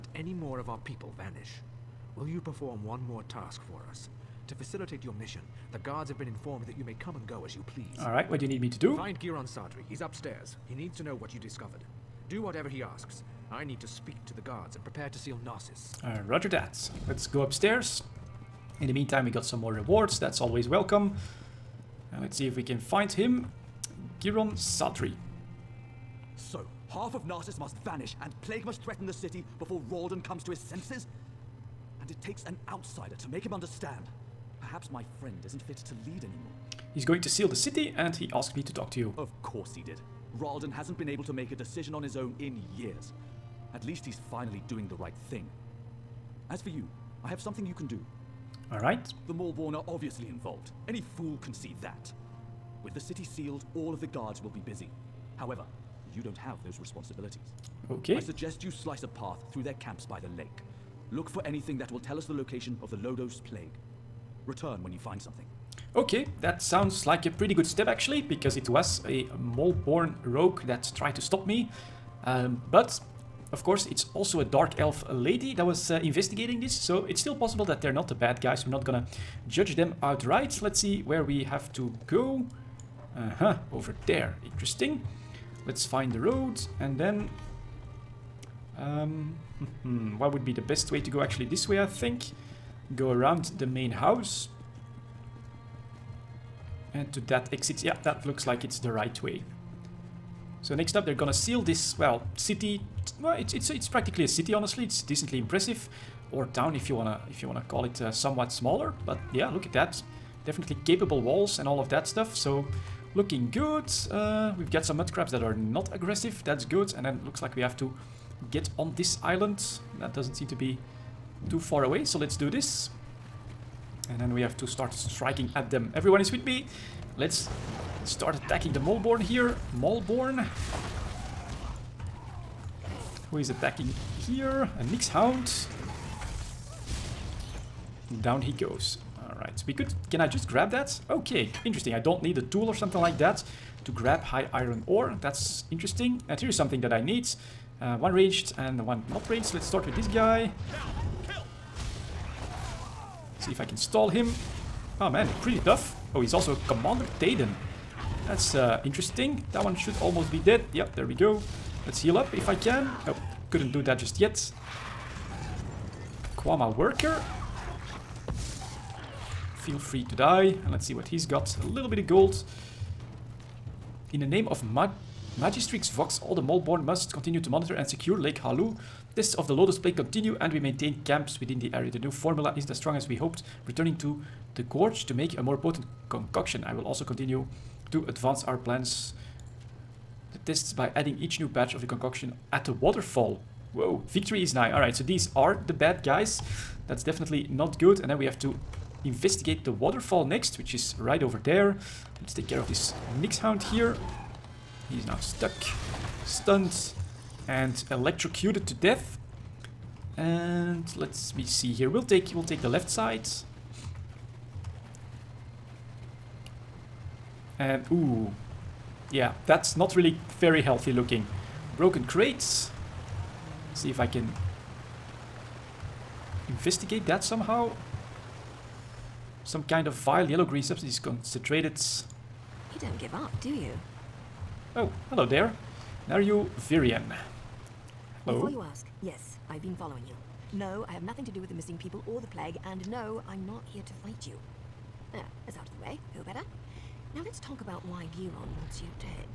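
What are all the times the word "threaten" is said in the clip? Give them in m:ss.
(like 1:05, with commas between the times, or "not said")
0:28.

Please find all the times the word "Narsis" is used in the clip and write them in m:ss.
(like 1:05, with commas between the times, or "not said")
0:15, 0:27.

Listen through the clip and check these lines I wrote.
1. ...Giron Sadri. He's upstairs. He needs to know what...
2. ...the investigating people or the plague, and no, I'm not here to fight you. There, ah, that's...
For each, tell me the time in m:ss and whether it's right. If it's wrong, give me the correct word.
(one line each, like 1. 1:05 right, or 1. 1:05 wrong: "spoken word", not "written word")
1. 0:09 right
2. 4:01 wrong: "missing", not "investigating".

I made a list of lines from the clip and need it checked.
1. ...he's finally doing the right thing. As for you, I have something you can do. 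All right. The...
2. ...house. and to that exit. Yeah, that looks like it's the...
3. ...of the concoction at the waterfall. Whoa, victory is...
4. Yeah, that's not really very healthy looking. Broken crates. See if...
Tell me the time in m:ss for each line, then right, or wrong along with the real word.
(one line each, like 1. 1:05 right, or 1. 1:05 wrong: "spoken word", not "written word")
1. 0:44 right
2. 1:33 right
3. 3:11 right
4. 3:39 right.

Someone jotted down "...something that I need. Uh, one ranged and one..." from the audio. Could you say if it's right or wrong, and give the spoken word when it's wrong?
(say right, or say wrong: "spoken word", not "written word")
right.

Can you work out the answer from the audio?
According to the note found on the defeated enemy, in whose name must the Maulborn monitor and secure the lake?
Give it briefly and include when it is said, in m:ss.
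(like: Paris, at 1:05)
Magistrix Vox, at 2:55.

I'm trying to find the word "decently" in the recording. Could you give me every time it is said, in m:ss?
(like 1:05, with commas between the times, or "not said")
1:45.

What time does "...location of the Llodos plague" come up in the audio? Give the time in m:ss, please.
1:02.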